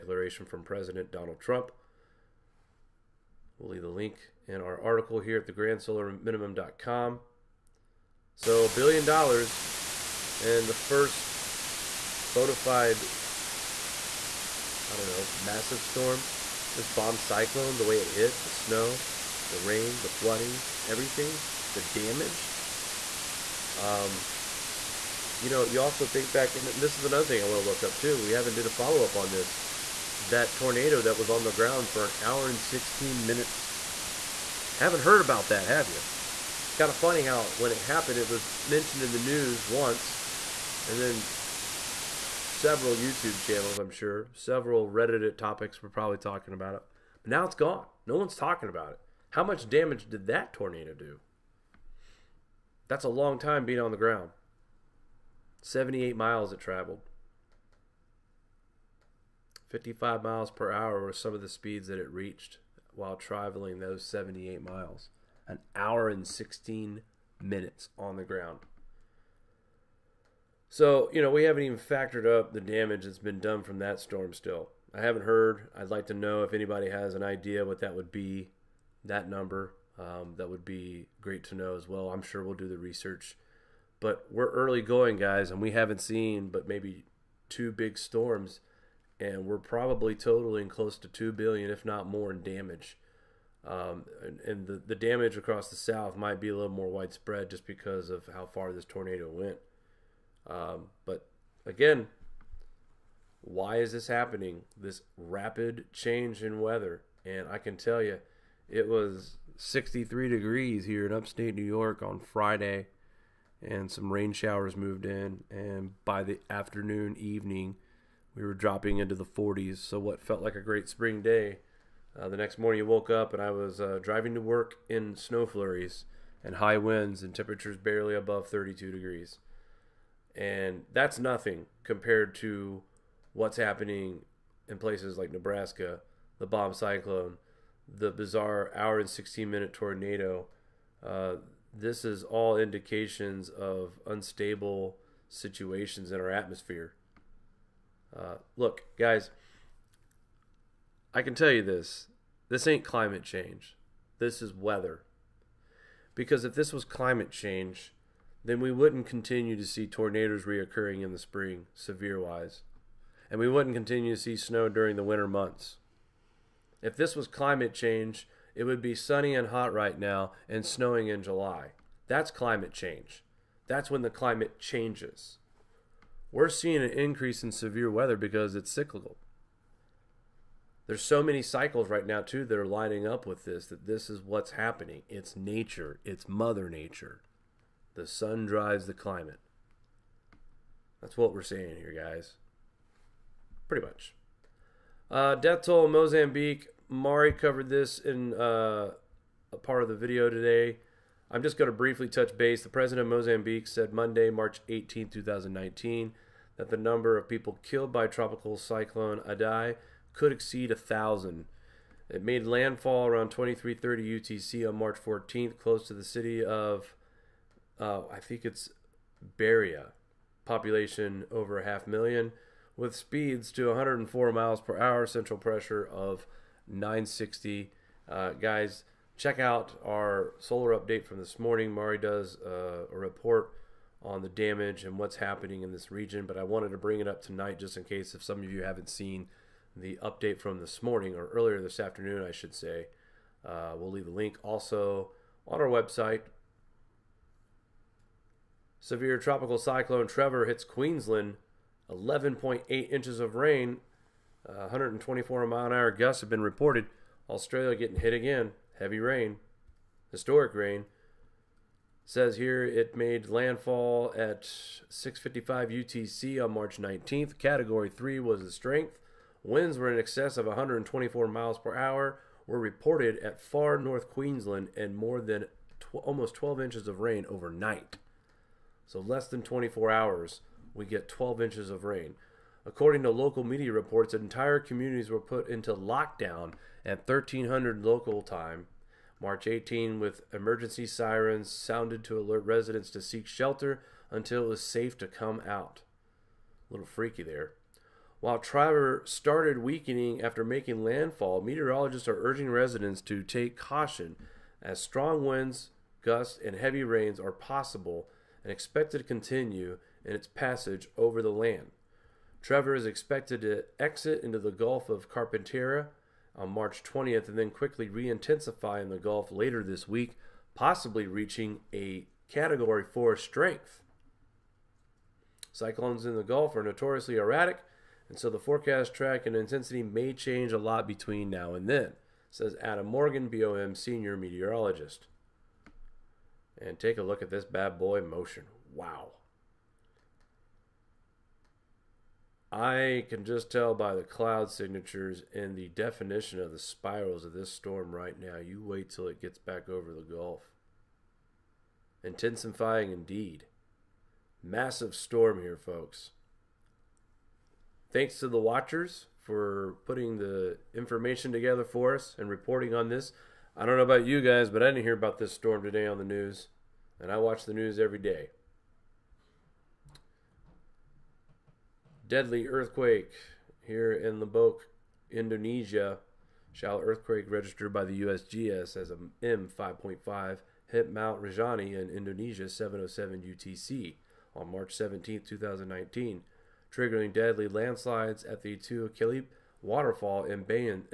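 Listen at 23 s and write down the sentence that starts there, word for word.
Um, you know, you also think back, and this is another thing I want to look up too.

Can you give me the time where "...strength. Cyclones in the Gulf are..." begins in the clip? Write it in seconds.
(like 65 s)
323 s.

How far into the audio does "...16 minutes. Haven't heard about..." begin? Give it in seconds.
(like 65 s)
32 s.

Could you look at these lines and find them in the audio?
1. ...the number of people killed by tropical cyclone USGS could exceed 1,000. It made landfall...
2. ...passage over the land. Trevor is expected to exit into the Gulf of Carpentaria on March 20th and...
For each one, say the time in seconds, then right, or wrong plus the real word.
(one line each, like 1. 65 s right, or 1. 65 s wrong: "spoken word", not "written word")
1. 206 s wrong: "Idai", not "USGS"
2. 310 s right.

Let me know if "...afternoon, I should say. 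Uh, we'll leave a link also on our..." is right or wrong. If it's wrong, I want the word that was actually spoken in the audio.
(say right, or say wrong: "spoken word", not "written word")
right.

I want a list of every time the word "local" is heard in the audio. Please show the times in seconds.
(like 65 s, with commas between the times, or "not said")
283 s, 287 s.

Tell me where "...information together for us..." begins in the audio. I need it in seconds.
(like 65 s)
360 s.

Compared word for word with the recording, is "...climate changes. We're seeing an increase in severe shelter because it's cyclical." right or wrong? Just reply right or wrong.
wrong.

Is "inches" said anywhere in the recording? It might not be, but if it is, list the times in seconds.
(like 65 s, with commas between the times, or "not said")
252 s, 276 s, 281 s.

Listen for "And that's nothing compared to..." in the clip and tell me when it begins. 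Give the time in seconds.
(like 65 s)
130 s.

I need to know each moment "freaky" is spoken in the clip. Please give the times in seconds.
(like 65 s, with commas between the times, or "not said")
296 s.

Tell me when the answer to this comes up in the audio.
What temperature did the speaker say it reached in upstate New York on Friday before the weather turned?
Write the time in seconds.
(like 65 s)
109 s.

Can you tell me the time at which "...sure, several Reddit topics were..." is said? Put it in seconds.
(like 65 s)
43 s.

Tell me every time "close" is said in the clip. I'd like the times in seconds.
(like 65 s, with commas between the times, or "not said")
90 s, 215 s.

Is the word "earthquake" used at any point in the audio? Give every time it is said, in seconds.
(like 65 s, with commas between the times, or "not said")
372 s, 376 s.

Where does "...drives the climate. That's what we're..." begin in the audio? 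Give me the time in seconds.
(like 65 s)
188 s.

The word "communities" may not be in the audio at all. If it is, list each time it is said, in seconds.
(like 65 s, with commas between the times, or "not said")
284 s.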